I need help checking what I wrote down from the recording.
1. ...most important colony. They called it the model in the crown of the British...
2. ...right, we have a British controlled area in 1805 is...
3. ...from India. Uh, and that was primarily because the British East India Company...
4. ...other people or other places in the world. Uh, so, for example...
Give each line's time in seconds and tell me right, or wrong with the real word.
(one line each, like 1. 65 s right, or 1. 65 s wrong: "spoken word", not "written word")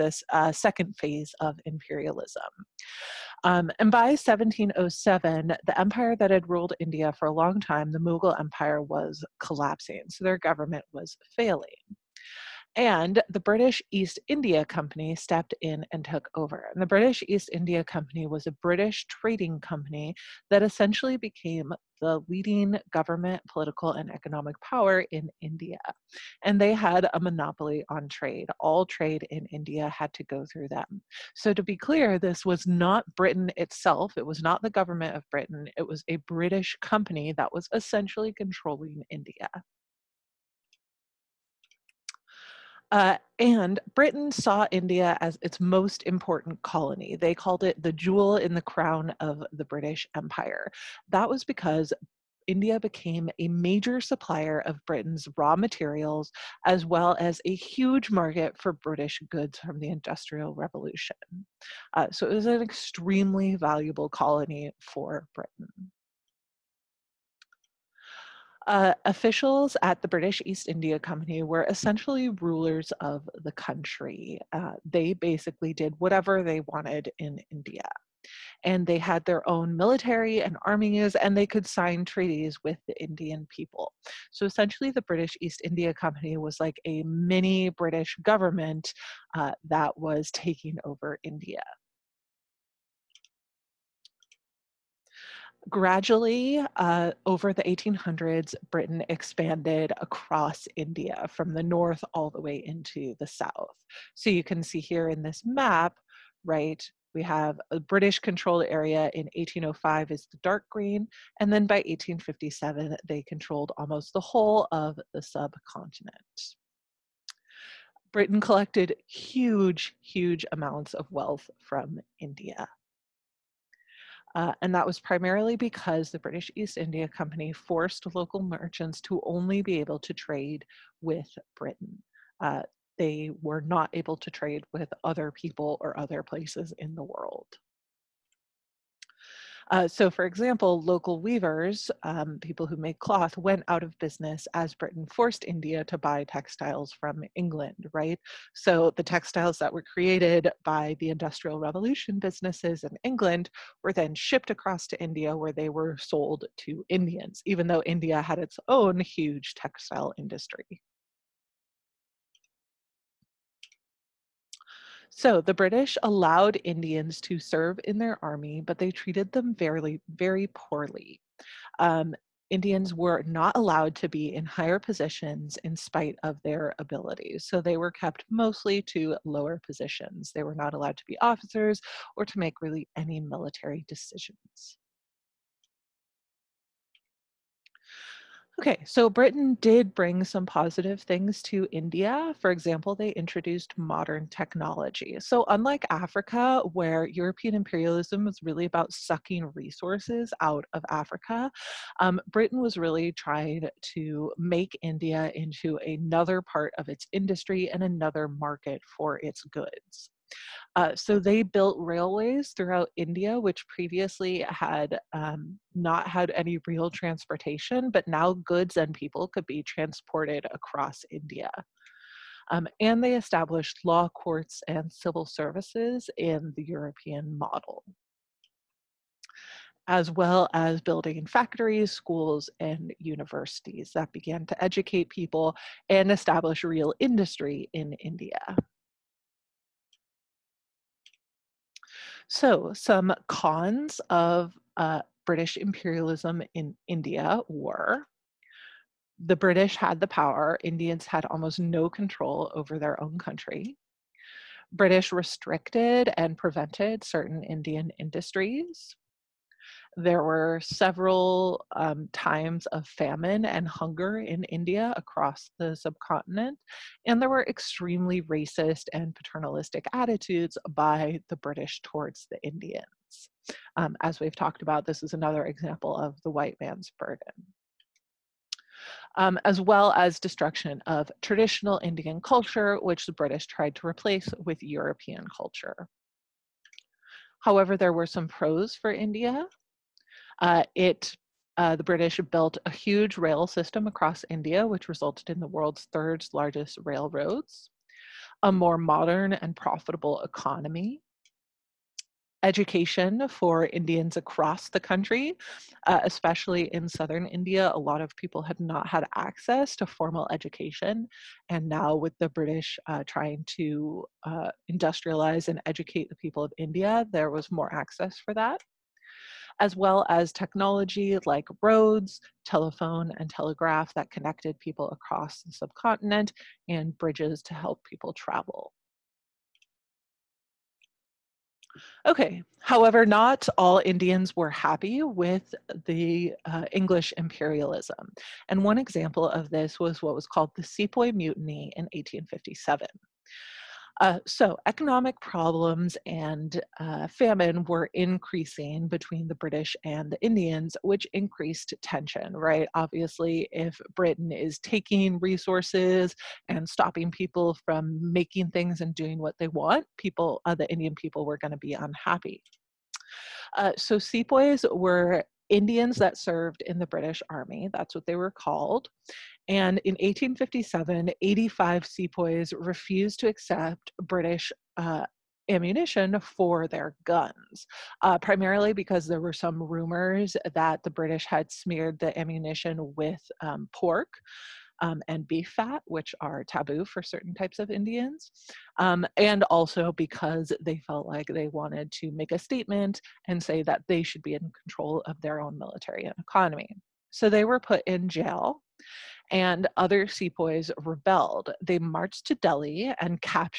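1. 45 s wrong: "jewel", not "model"
2. 106 s right
3. 121 s right
4. 135 s right.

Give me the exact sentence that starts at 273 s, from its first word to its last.
Um, as we've talked about, this is another example of the white man's burden.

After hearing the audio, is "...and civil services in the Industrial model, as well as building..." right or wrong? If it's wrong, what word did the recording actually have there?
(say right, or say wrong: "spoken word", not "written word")
wrong: "European", not "Industrial".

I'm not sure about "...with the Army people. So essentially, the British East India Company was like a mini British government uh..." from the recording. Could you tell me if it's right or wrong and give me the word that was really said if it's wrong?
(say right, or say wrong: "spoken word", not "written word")
wrong: "Indian", not "Army".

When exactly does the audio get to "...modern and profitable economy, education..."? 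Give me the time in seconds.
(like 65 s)
298 s.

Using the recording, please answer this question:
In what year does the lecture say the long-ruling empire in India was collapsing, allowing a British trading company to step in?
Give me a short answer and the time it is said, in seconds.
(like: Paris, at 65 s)
1707, at 4 s.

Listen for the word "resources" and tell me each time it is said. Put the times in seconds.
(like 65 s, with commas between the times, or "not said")
199 s, 355 s.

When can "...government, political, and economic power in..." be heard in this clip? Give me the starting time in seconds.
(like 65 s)
22 s.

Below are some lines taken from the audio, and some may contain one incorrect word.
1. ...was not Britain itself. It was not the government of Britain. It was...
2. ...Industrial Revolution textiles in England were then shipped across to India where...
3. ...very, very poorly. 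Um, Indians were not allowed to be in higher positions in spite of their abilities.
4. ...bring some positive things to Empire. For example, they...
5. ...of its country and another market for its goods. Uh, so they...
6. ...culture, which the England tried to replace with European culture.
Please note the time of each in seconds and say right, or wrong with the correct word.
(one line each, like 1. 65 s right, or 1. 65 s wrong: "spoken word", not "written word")
1. 32 s right
2. 151 s wrong: "businesses", not "textiles"
3. 169 s right
4. 189 s wrong: "India", not "Empire"
5. 206 s wrong: "industry", not "country"
6. 282 s wrong: "British", not "England".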